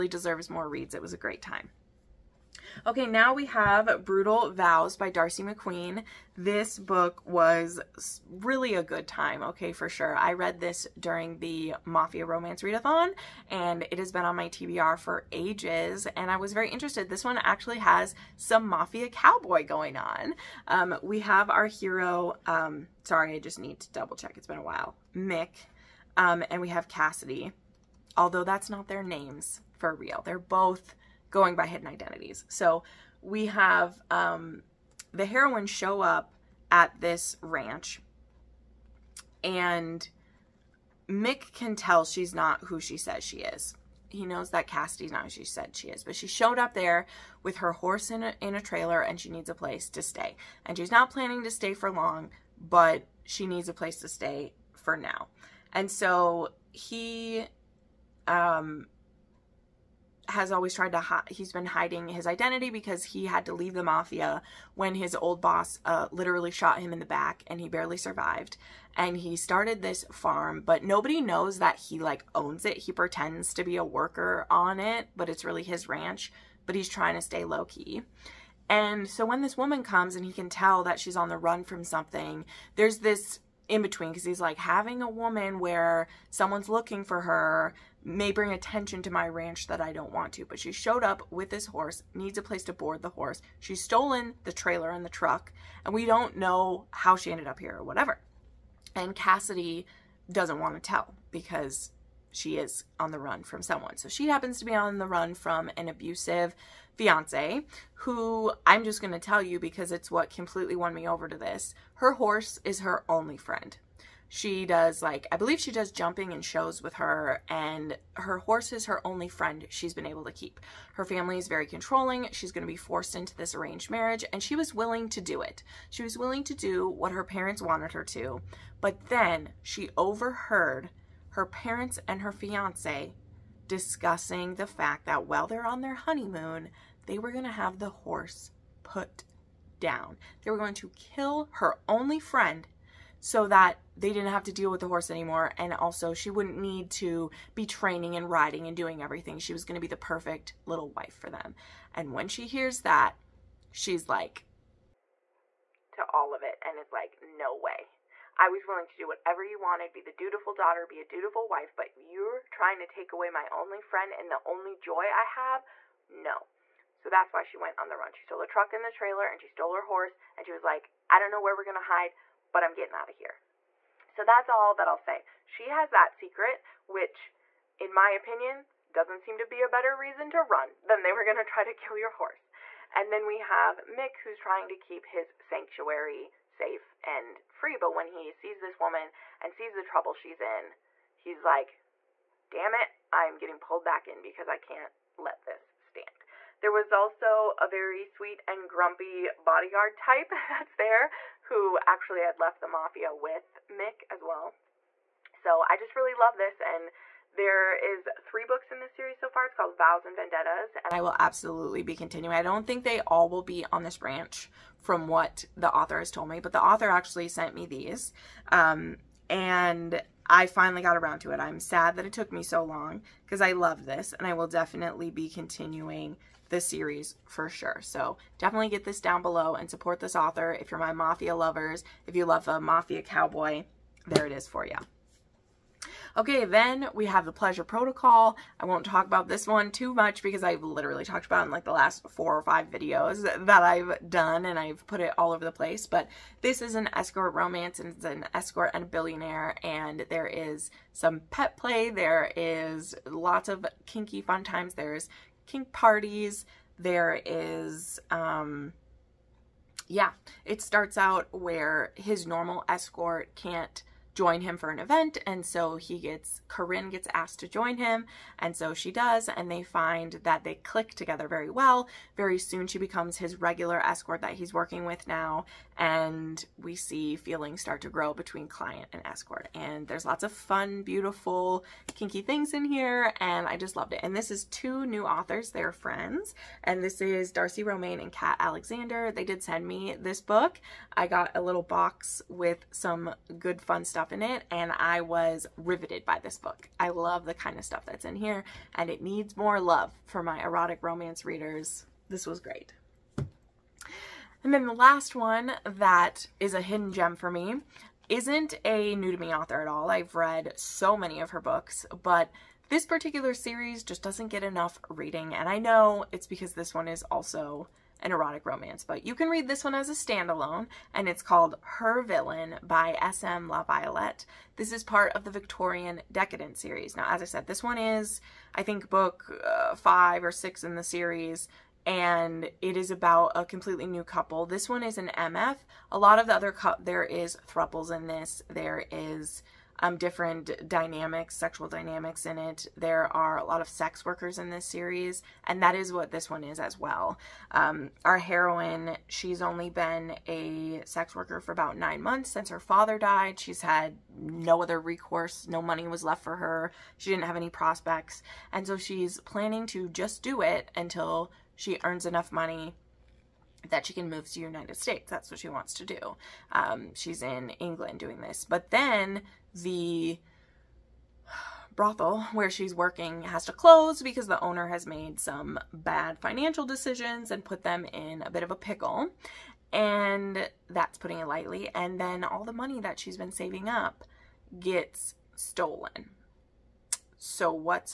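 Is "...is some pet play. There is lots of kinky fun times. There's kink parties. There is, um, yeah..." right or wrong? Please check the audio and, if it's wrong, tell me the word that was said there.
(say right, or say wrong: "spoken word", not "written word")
right.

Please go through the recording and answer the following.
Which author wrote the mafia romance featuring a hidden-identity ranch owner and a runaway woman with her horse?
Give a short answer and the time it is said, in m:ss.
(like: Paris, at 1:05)
Darcy McQueen, at 0:05.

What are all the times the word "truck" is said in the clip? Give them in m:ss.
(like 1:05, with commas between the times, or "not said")
1:35, 2:48.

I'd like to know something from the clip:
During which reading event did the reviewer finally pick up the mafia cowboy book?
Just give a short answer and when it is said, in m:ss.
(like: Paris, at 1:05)
Mafia Romance Readathon, at 0:11.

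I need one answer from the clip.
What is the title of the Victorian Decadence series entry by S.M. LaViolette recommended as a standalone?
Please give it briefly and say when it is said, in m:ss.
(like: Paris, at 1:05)
Her Villain, at 5:21.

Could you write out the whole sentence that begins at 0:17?
This one actually has some Mafia Cowboy going on.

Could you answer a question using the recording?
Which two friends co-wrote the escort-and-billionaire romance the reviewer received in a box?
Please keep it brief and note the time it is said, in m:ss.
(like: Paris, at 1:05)
Darcy Romaine and Kat Alexander, at 4:47.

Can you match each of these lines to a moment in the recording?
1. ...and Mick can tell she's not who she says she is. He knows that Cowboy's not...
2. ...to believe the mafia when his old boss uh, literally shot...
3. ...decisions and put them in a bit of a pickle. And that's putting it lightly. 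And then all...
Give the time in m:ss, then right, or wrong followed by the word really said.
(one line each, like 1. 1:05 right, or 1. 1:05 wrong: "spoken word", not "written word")
1. 0:39 wrong: "Cassidy", not "Cowboy"
2. 1:03 wrong: "leave", not "believe"
3. 6:16 right.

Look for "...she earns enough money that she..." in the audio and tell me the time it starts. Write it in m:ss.
6:01.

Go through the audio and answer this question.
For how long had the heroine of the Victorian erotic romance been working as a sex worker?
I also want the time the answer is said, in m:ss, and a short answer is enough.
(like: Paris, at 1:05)
9 months, at 5:51.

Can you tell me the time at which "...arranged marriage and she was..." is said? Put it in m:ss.
2:03.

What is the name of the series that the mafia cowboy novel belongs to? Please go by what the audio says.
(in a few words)
Vows and Vendettas.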